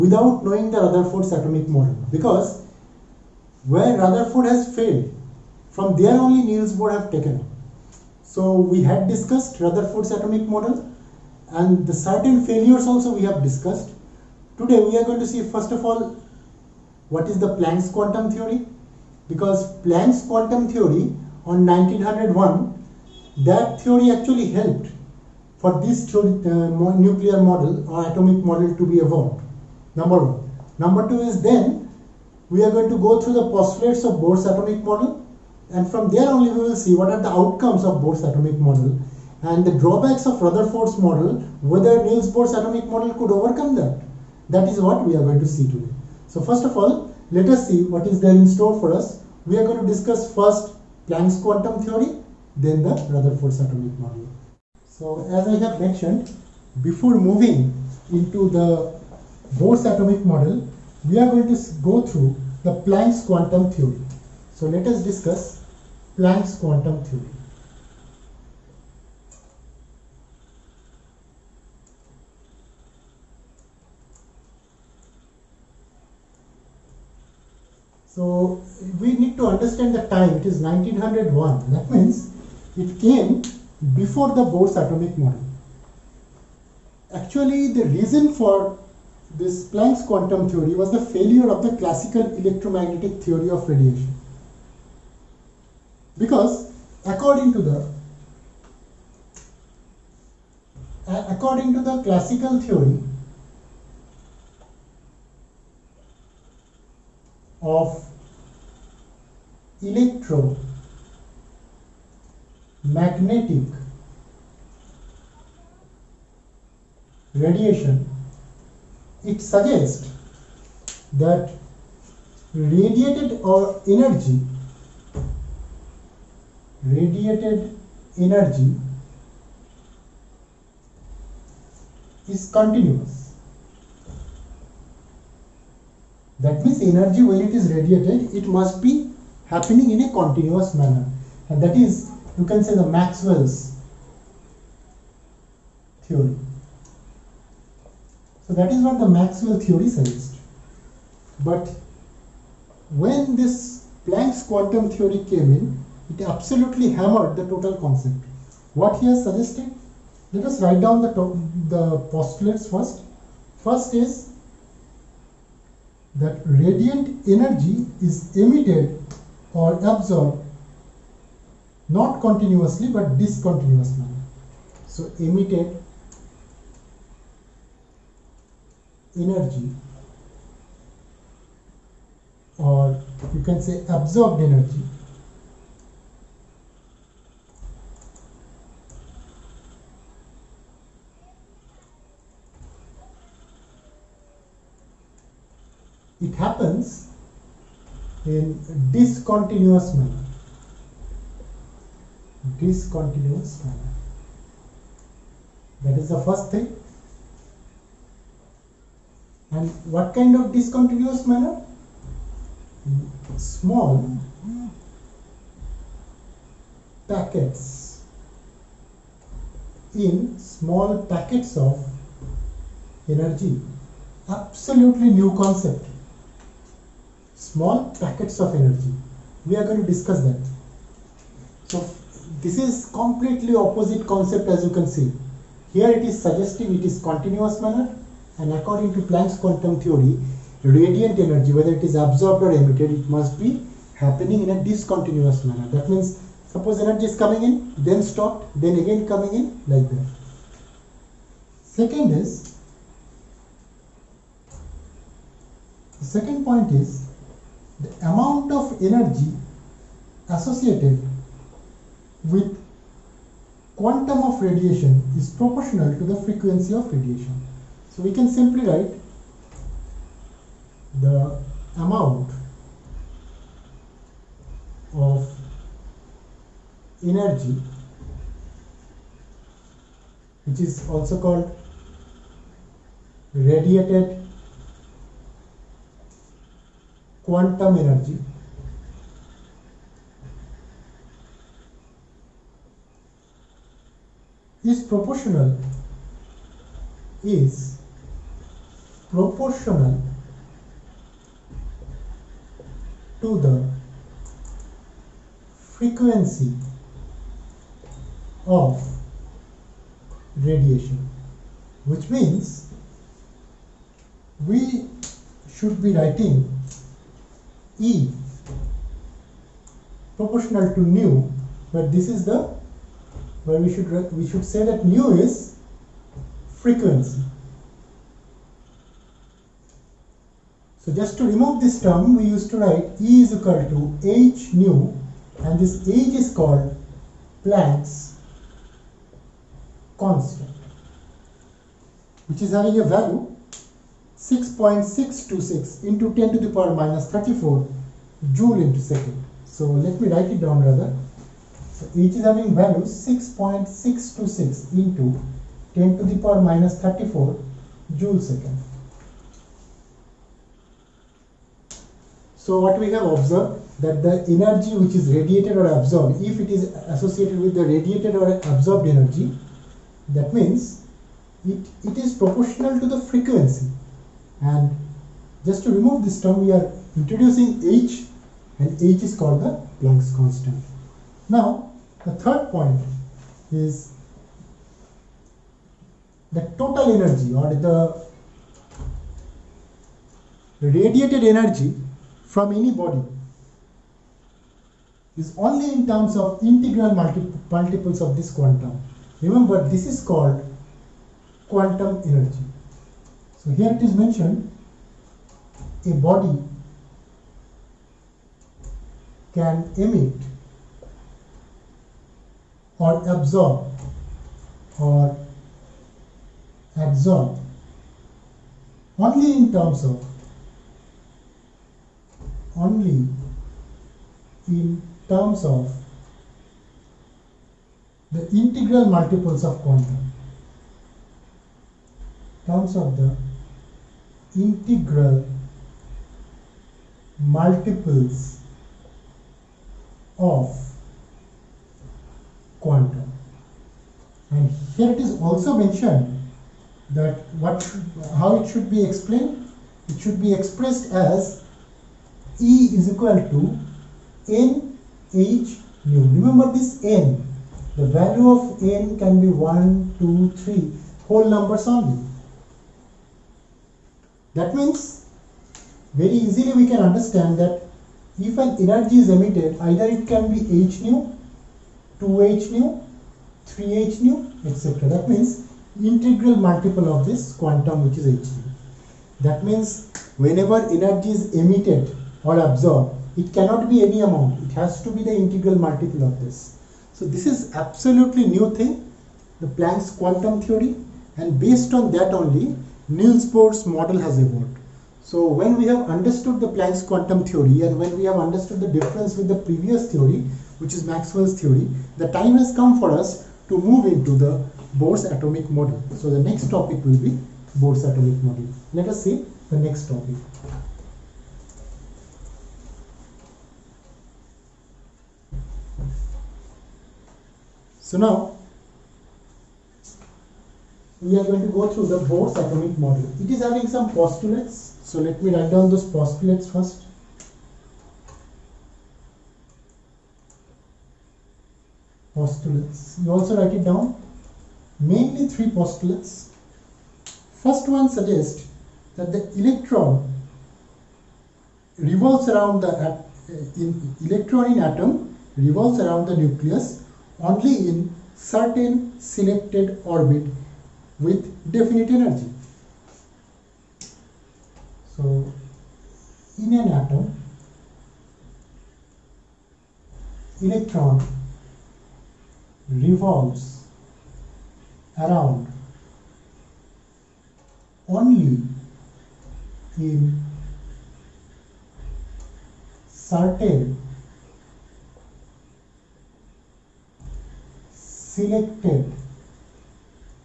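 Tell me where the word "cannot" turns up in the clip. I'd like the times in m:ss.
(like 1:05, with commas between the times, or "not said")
8:03.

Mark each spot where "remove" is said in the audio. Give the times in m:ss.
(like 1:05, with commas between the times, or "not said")
5:31, 6:15.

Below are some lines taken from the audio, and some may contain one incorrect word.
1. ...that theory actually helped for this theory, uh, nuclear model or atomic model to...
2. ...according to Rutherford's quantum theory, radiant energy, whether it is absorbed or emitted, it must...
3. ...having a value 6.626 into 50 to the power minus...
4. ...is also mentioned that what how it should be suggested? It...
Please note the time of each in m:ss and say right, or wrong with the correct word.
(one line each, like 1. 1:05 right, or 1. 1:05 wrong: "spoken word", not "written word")
1. 0:23 right
2. 3:58 wrong: "Planck", not "Rutherford"
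3. 5:42 wrong: "10", not "50"
4. 7:24 wrong: "explained", not "suggested".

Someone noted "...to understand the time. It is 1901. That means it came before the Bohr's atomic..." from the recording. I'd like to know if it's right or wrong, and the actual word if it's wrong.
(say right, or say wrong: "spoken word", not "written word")
right.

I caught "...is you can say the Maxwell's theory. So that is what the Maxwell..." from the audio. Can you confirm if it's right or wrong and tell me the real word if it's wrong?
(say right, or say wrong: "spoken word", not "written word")
right.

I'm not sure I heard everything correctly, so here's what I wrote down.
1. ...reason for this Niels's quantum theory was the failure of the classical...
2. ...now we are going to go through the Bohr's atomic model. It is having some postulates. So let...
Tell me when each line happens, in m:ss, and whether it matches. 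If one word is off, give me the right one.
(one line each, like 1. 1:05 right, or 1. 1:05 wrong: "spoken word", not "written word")
1. 1:27 wrong: "Planck", not "Niels"
2. 8:37 right.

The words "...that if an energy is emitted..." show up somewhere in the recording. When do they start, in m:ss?
7:47.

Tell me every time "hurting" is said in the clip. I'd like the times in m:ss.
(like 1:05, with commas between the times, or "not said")
not said.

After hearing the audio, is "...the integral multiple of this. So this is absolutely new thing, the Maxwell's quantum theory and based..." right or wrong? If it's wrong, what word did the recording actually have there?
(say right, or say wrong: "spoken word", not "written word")
wrong: "Planck", not "Maxwell".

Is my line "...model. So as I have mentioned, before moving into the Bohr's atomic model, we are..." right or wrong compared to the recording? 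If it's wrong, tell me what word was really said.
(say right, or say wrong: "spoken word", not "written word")
right.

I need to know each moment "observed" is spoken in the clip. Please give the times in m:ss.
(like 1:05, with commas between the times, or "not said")
6:03.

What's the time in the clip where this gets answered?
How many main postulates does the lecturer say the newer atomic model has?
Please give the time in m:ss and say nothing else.
8:55.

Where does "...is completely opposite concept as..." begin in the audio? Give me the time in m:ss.
3:52.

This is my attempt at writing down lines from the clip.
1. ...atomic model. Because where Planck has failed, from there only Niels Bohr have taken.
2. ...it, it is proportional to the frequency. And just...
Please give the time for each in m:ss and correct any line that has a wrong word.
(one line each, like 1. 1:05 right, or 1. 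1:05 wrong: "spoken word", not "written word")
1. 0:01 wrong: "Rutherford", not "Planck"
2. 6:11 right.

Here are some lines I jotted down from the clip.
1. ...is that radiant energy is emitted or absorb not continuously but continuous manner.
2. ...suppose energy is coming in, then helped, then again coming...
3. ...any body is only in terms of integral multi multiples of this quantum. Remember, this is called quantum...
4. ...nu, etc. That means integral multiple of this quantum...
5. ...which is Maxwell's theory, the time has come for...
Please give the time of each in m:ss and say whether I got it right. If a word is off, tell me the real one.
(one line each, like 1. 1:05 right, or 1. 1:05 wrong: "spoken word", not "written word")
1. 2:43 wrong: "discontinuous", not "continuous"
2. 4:06 wrong: "stopped", not "helped"
3. 6:32 right
4. 7:54 right
5. 8:20 right.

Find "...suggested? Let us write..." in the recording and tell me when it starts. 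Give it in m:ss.
2:39.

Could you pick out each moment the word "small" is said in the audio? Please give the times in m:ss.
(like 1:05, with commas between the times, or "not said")
3:33, 3:40, 3:47.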